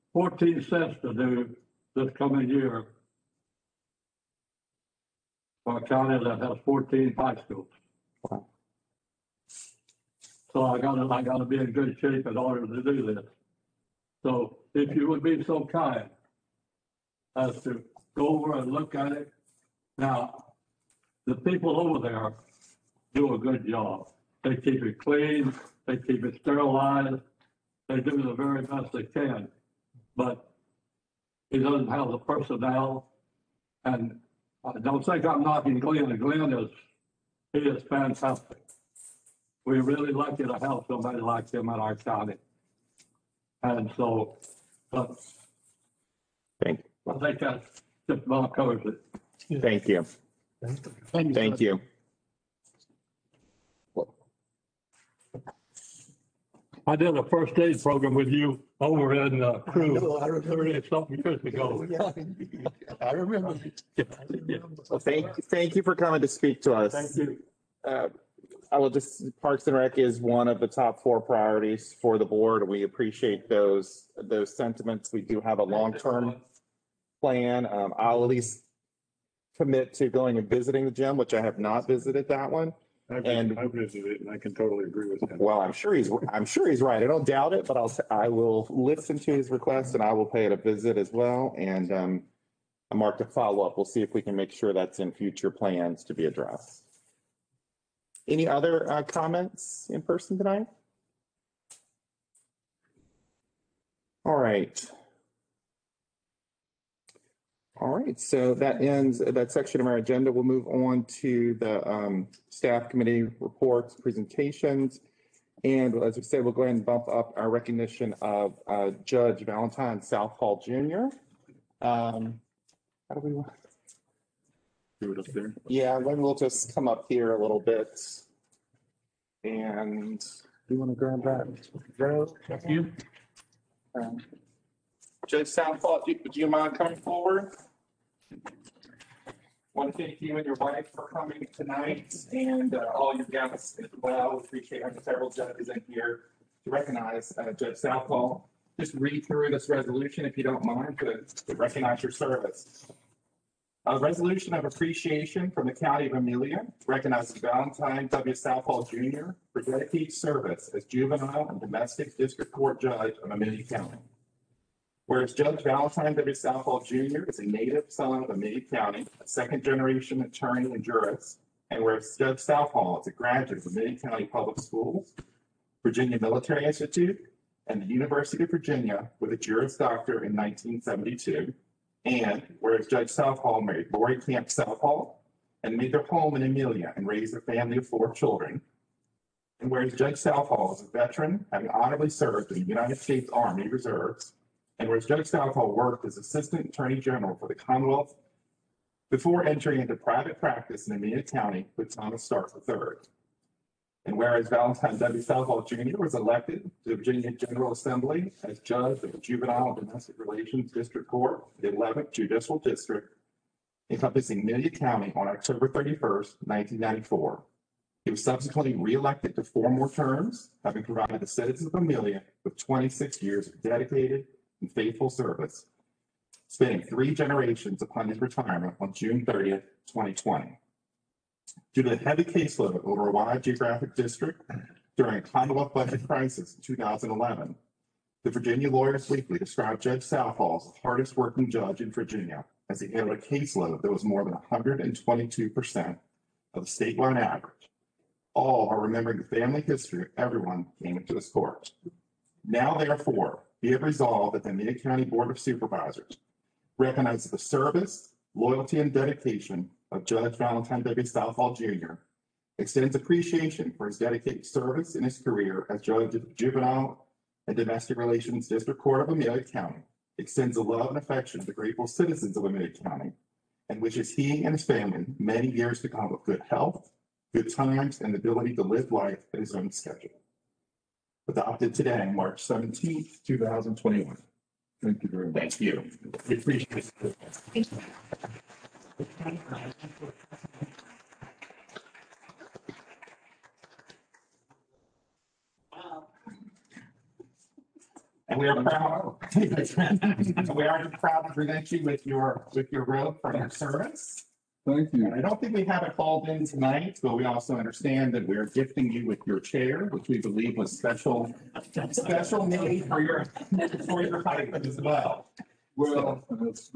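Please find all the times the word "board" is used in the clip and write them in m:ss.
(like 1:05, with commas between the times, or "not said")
1:12, 4:15.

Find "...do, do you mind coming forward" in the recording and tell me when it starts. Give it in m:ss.
2:16.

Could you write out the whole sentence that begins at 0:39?
we really lucky to have somebody like him in our county.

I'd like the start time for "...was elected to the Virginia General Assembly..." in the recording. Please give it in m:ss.
3:25.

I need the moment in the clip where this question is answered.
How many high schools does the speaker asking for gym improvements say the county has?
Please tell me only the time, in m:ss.
0:06.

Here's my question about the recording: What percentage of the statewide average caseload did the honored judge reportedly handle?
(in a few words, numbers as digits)
122%.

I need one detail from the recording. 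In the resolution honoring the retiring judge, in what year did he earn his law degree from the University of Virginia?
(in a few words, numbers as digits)
1972.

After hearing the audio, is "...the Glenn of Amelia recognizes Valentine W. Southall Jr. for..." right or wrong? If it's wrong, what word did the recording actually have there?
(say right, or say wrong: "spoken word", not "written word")
wrong: "County", not "Glenn".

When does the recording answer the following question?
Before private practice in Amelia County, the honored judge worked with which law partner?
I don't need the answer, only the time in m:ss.
3:21.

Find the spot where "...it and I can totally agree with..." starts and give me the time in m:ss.
1:24.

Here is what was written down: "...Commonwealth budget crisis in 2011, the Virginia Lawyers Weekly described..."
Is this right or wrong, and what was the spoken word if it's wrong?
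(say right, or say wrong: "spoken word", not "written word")
right.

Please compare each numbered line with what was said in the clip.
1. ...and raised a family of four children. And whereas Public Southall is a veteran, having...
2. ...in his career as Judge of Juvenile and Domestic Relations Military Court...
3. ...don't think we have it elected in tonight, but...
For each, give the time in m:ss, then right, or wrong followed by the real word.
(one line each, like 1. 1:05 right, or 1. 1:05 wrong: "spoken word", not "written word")
1. 3:06 wrong: "Judge", not "Public"
2. 4:24 wrong: "District", not "Military"
3. 5:05 wrong: "called", not "elected".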